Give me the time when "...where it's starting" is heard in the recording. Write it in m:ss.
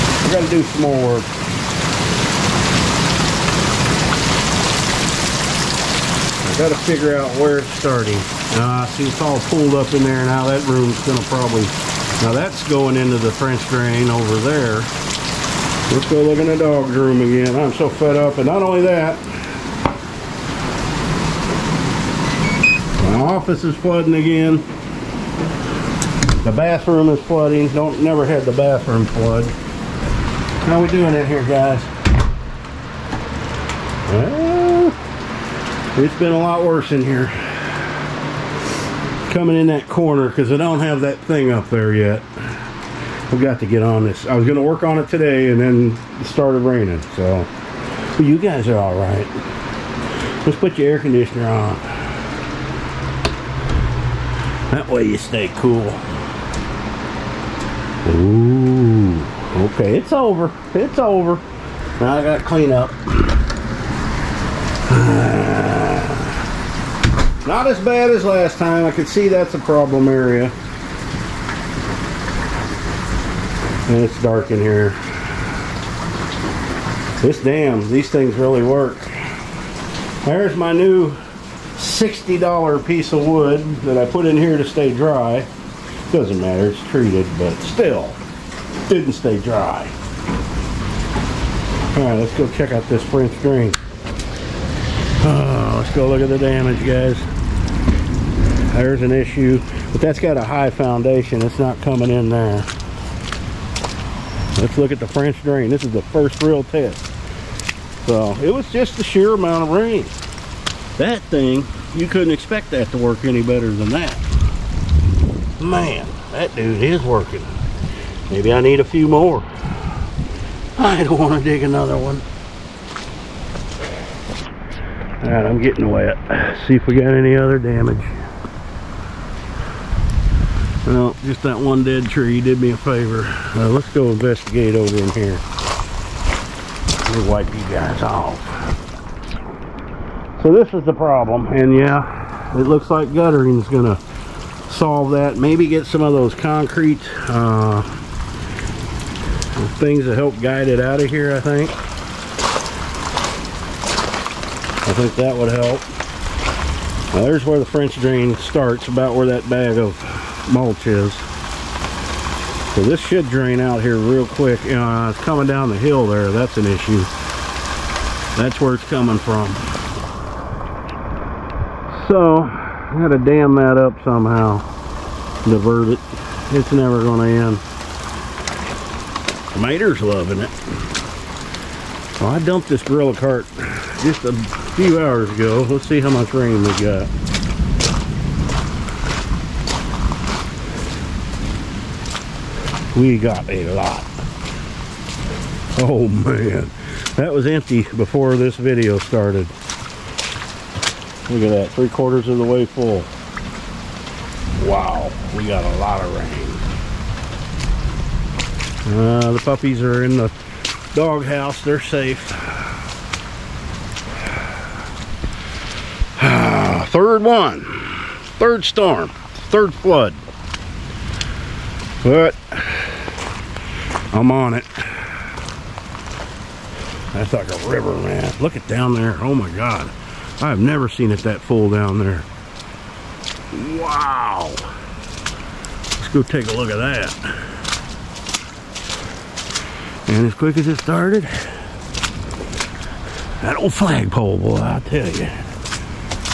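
0:07.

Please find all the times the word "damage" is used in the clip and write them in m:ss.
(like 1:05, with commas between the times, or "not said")
1:36, 2:07.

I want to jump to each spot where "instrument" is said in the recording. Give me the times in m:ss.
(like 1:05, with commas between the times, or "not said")
not said.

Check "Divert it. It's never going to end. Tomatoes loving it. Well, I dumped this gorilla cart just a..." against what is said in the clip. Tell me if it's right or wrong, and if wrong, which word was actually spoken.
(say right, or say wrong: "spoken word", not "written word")
right.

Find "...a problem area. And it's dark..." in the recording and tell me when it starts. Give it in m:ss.
1:09.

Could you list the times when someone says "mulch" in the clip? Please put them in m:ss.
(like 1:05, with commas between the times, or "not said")
2:40.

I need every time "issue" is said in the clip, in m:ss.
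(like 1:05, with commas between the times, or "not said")
1:39, 2:46.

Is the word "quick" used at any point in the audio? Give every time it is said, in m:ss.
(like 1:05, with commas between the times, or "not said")
2:44, 4:00.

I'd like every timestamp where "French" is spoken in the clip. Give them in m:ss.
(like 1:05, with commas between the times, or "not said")
0:13, 1:33, 1:45, 2:37.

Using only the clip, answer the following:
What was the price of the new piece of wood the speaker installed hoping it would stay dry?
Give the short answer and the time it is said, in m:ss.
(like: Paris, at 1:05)
$60, at 1:21.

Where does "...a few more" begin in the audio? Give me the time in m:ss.
1:58.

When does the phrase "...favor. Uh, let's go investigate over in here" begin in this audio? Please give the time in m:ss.
2:12.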